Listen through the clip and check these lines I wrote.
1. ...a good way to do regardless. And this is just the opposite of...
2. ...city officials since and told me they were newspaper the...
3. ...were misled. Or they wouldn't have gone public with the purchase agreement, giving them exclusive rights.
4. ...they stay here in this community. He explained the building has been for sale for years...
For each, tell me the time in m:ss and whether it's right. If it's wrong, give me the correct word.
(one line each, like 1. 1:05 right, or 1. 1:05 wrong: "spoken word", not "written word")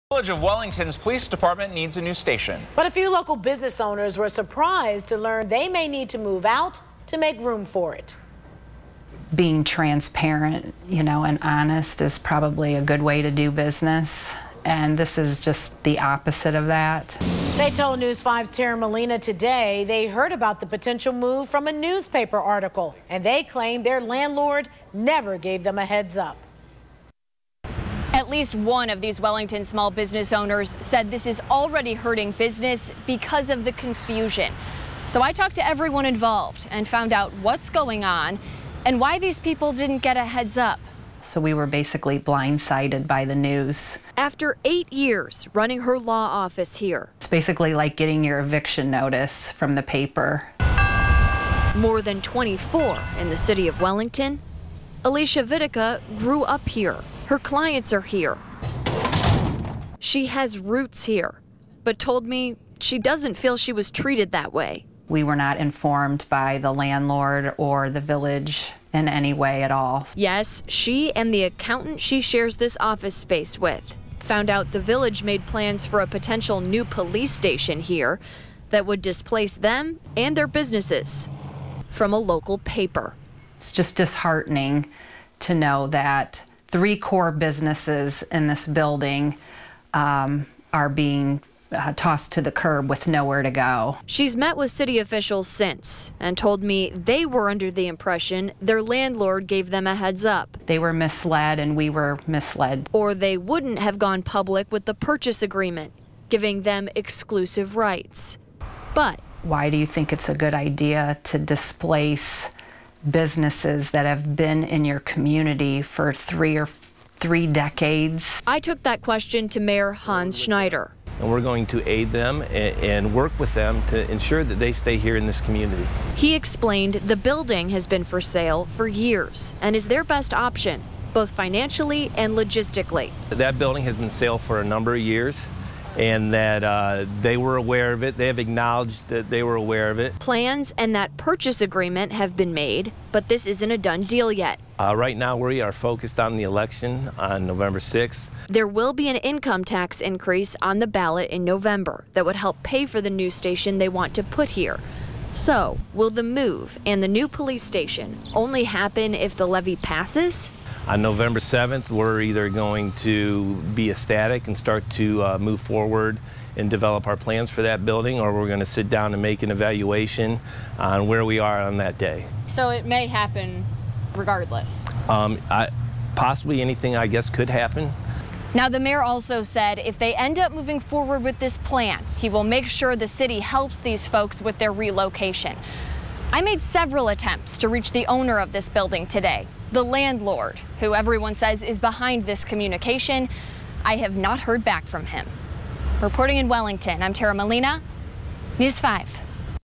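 1. 0:12 wrong: "business", not "regardless"
2. 1:34 wrong: "under", not "newspaper"
3. 1:41 right
4. 2:04 right.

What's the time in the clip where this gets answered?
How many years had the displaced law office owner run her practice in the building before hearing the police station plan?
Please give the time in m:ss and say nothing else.
0:44.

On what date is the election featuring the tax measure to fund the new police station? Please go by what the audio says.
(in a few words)
November 6.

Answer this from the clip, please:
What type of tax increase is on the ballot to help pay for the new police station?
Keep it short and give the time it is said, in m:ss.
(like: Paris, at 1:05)
Income tax, at 2:29.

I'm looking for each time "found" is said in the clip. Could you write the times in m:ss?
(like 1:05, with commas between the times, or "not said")
0:36, 1:14.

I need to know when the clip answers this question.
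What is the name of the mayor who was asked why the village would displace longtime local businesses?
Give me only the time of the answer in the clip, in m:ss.
1:59.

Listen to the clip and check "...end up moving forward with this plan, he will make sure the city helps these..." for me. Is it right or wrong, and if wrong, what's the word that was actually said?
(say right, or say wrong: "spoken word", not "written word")
right.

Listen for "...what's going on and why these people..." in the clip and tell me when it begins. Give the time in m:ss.
0:37.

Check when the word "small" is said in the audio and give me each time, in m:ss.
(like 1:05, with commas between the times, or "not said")
0:29.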